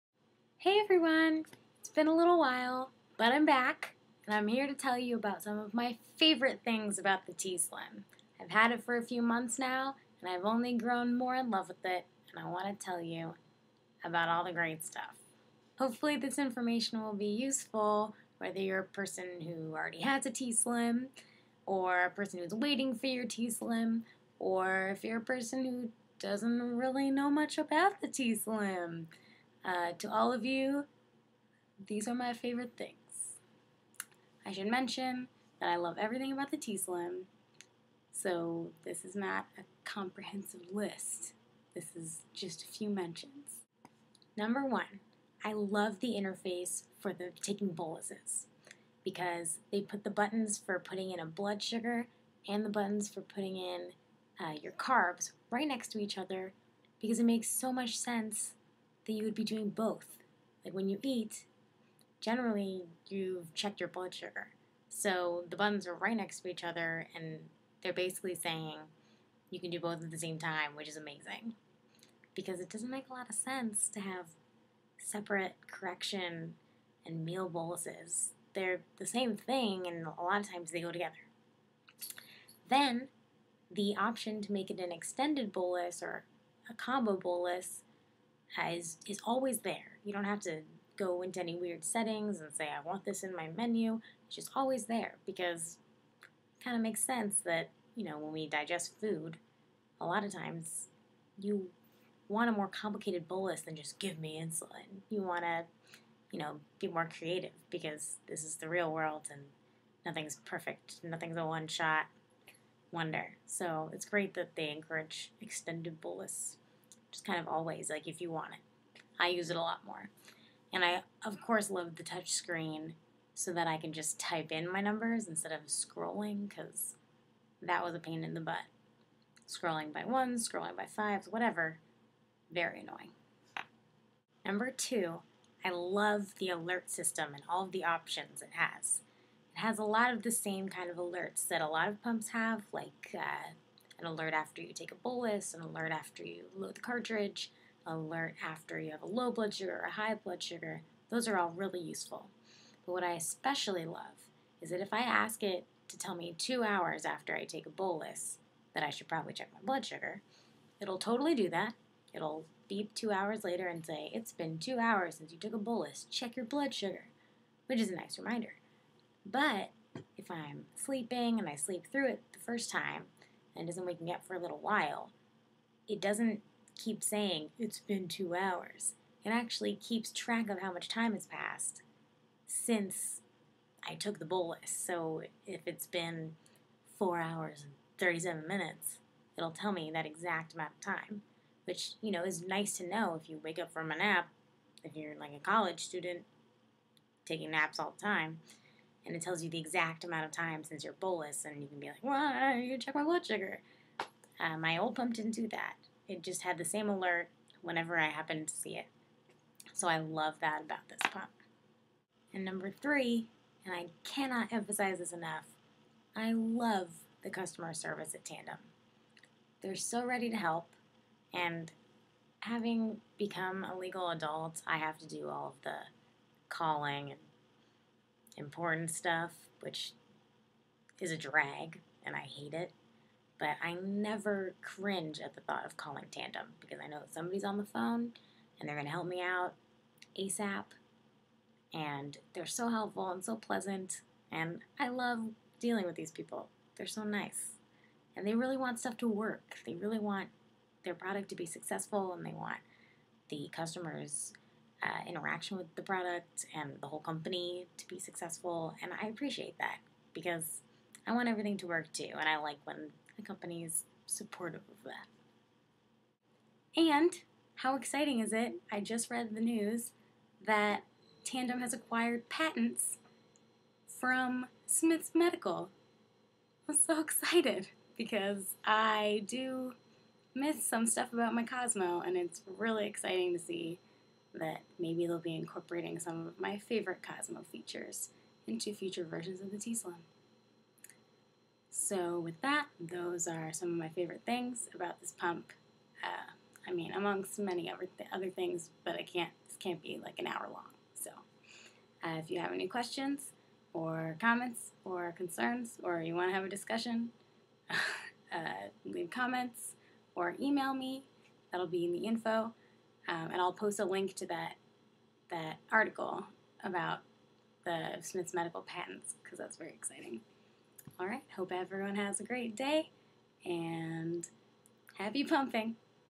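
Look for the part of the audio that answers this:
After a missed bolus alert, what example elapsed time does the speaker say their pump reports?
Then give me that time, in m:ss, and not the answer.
3:06.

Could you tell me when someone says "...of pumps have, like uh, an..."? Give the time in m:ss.
2:21.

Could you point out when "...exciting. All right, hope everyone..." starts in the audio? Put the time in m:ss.
5:19.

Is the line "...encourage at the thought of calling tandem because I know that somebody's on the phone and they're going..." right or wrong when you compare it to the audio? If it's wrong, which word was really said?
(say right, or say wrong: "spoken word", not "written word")
wrong: "cringe", not "encourage".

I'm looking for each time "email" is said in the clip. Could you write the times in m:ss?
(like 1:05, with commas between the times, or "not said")
5:10.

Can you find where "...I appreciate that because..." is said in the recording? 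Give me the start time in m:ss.
4:19.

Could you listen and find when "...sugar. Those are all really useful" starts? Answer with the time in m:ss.
2:30.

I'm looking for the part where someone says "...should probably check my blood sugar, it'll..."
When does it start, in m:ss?
2:38.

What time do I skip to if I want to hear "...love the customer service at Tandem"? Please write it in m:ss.
3:36.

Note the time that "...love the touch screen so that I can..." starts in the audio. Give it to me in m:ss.
2:01.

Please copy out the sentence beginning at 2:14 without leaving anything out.
Number two, I love the alert system and all of the options it has.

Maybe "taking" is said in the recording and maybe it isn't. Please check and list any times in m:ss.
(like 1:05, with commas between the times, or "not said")
0:47, 3:17.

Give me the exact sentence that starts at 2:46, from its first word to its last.
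Check your blood sugar, which is a nice reminder.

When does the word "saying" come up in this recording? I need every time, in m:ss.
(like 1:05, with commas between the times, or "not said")
1:08, 2:57.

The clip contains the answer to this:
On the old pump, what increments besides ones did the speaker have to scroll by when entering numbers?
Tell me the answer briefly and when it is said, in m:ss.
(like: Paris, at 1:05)
fives, at 2:10.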